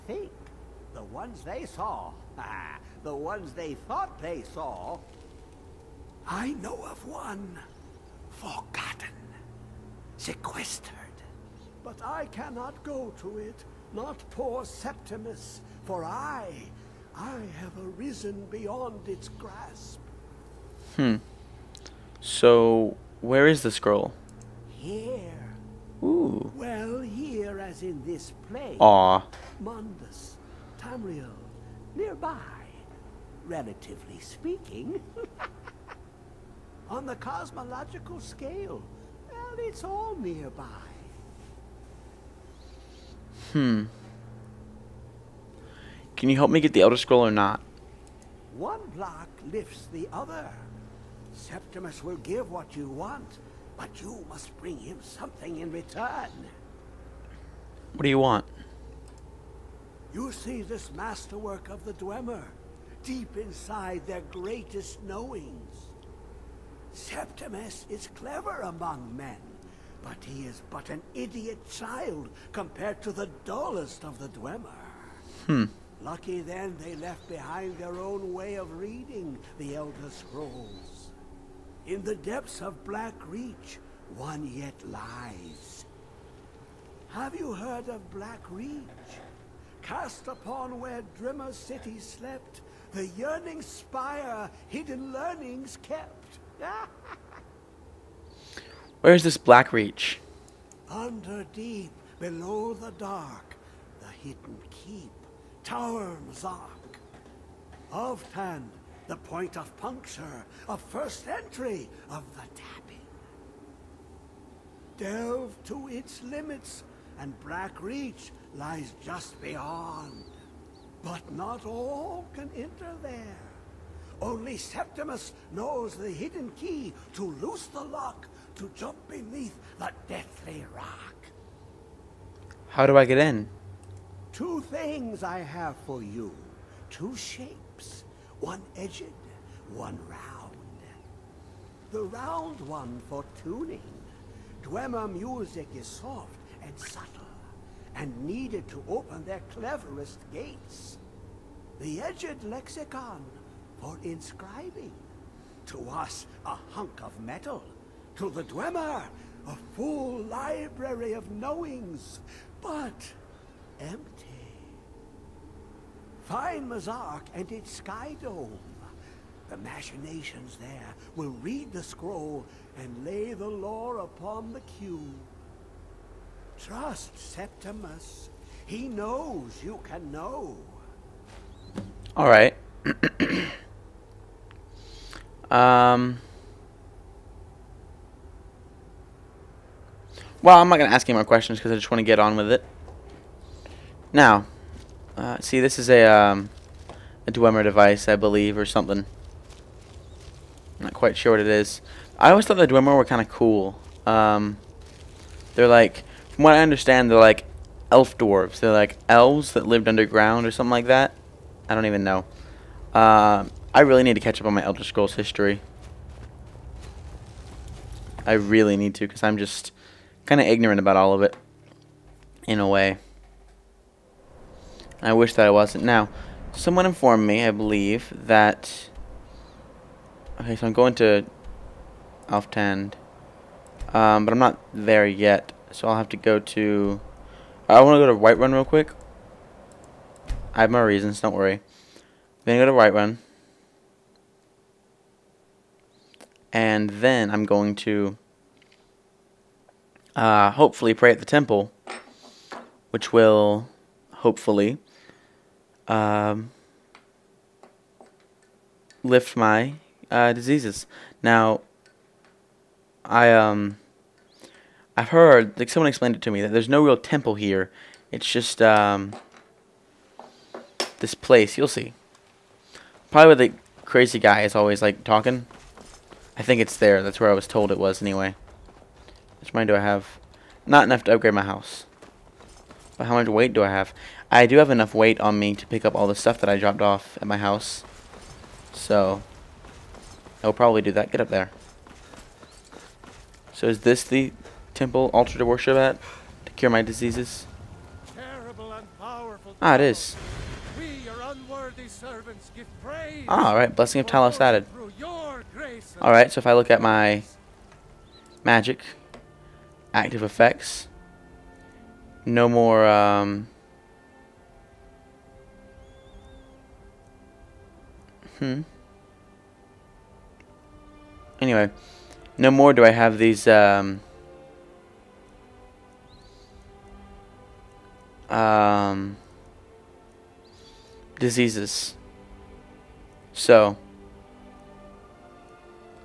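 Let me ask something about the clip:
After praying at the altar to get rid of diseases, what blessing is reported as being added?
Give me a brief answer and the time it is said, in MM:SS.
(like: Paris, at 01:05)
Blessing of Talos, at 05:03.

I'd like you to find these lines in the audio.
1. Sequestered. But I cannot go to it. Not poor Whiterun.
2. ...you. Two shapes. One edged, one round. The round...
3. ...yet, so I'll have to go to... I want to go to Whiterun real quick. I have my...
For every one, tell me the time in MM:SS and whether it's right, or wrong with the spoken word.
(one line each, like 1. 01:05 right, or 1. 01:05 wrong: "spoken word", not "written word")
1. 00:10 wrong: "Septimus", not "Whiterun"
2. 02:16 right
3. 03:55 right.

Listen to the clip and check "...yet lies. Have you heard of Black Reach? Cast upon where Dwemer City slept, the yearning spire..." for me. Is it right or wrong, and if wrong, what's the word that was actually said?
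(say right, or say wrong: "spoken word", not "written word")
right.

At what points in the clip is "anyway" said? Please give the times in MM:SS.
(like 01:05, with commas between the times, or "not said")
04:38, 05:21.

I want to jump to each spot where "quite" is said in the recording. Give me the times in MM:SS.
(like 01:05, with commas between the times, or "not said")
03:20.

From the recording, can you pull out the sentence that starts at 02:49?
The machinations there will read the scroll and lay the lore upon the cube.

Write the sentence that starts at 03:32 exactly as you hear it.
Uh, I really need to catch up on my Elder Scrolls history.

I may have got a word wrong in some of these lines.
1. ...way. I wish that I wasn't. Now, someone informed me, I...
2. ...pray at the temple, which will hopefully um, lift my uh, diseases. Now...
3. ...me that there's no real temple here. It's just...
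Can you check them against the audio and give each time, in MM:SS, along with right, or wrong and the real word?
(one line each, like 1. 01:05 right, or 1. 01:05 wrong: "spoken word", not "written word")
1. 03:42 right
2. 04:10 right
3. 04:26 right.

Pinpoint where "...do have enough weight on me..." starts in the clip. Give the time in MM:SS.
04:44.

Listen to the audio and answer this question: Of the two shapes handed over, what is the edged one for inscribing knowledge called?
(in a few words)
Lexicon.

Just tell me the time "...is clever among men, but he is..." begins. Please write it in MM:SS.
01:07.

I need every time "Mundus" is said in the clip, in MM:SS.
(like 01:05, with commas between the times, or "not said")
00:29.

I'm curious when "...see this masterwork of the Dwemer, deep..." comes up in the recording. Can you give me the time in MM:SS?
01:00.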